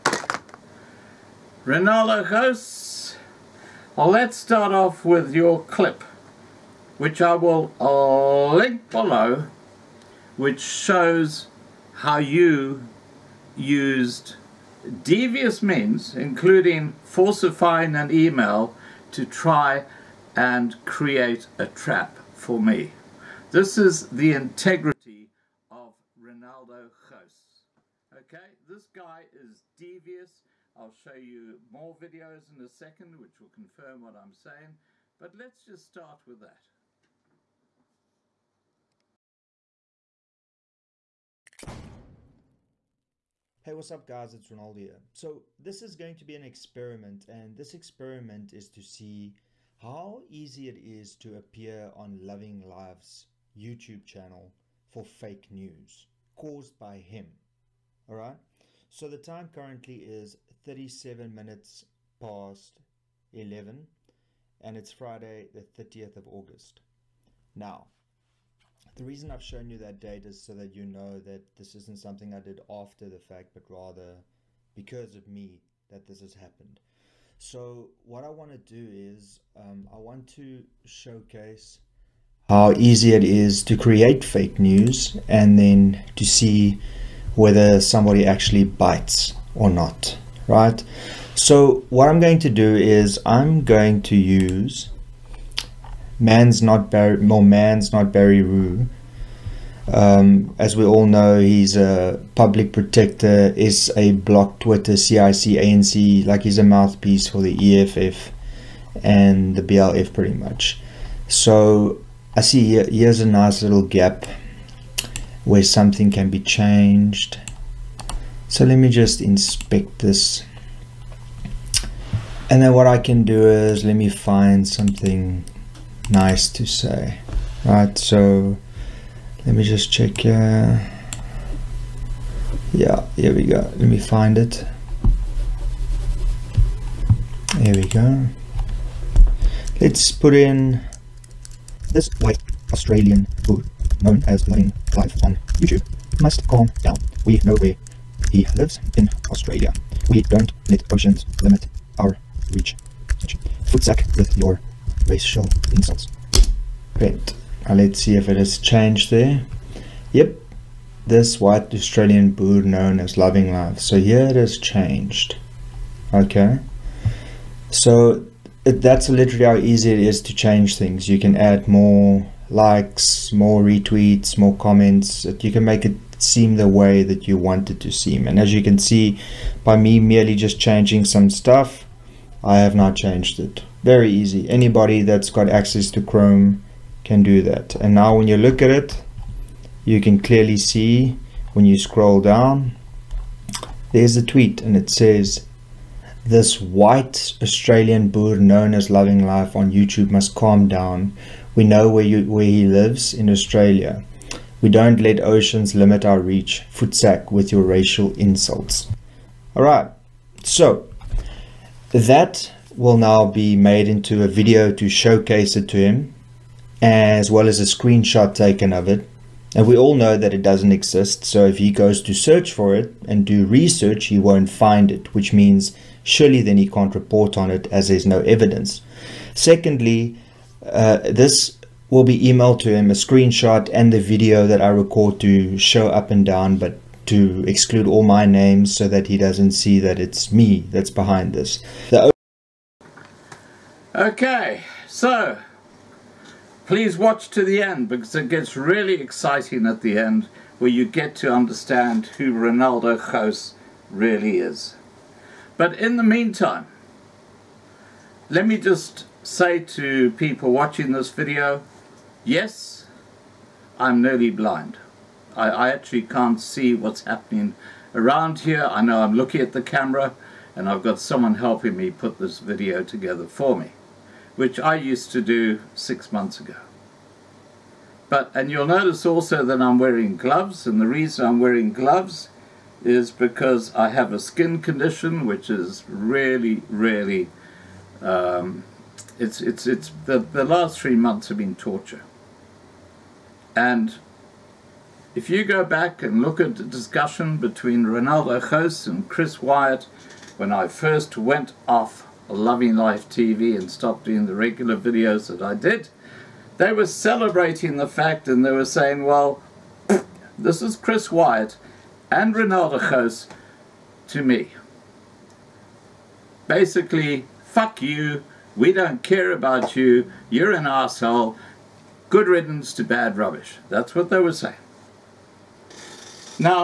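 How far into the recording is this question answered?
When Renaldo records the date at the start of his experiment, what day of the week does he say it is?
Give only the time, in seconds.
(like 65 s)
64 s.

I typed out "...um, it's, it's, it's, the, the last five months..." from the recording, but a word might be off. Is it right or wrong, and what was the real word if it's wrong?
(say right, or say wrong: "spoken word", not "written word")
wrong: "three", not "five".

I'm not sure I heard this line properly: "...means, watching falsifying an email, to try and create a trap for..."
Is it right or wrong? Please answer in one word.
wrong.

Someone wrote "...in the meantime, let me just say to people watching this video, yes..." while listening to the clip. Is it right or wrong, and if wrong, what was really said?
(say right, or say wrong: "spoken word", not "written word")
right.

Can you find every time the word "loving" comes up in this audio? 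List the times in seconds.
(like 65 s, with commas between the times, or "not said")
52 s, 163 s, 198 s, 302 s.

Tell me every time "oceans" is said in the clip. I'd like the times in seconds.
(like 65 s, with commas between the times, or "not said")
150 s, 205 s.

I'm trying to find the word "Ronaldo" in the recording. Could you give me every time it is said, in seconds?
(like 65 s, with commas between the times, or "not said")
297 s, 312 s.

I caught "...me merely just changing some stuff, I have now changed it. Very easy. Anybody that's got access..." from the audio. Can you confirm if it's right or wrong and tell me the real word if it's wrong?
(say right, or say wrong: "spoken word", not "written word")
right.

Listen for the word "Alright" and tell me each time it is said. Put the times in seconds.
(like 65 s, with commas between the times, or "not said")
58 s.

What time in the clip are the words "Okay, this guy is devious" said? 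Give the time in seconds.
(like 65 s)
28 s.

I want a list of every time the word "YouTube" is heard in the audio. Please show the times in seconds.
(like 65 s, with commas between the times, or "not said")
53 s, 145 s, 199 s.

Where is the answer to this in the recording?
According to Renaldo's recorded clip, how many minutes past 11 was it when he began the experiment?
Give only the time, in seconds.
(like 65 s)
60 s.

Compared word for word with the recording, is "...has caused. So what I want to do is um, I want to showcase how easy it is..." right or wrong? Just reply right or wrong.
wrong.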